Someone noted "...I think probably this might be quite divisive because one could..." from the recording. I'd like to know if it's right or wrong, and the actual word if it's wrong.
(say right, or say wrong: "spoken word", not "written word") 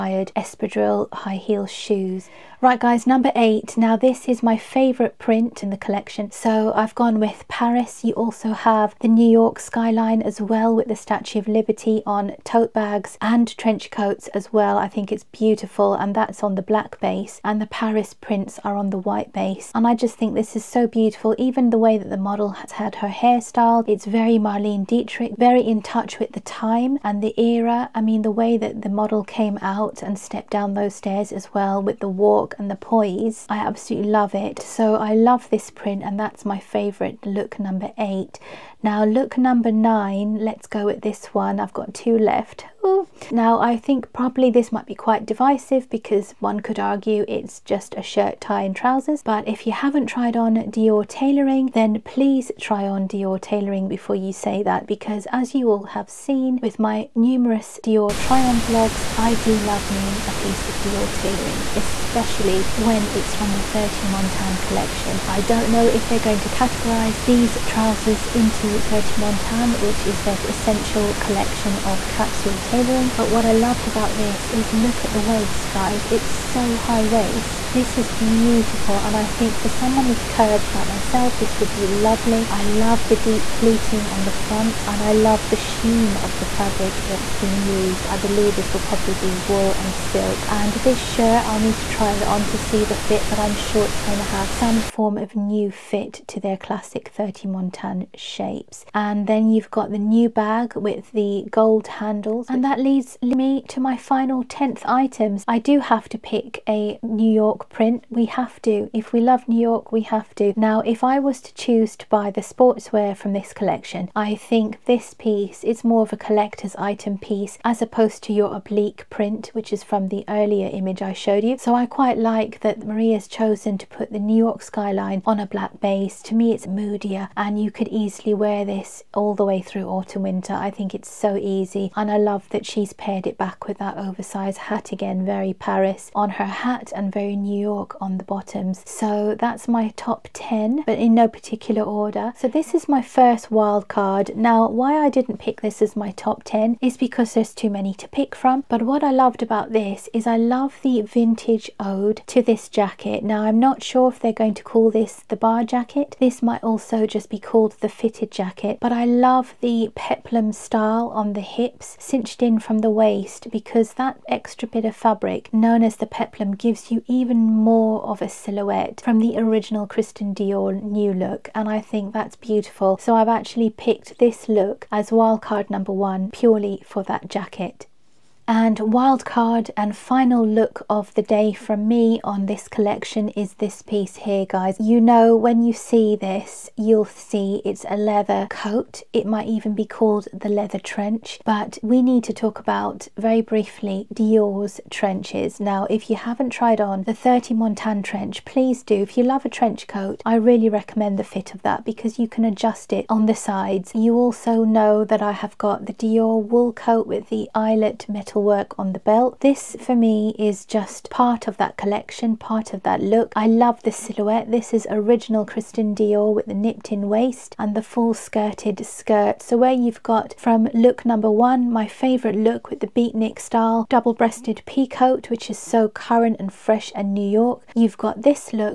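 right.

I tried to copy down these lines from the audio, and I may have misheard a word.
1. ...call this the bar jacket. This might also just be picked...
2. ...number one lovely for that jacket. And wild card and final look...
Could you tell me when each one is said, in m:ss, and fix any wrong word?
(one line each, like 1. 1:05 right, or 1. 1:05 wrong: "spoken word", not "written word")
1. 2:34 wrong: "called", not "picked"
2. 2:55 wrong: "purely", not "lovely".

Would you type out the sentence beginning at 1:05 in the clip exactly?
I don't know if they're going to categorize these trousers into 30 Montaigne, which is their essential collection of capsule tailoring tailoring.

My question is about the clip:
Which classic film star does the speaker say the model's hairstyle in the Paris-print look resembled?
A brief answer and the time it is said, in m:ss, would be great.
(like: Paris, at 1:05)
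Marlene Dietrich, at 0:24.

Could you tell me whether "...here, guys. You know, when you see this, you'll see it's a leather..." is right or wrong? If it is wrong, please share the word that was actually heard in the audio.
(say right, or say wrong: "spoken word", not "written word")
right.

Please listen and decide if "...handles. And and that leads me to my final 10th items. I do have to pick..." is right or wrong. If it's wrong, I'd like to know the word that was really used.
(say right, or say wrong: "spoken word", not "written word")
right.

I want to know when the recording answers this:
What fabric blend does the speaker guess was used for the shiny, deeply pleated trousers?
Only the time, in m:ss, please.
1:29.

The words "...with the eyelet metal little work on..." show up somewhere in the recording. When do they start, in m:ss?
3:27.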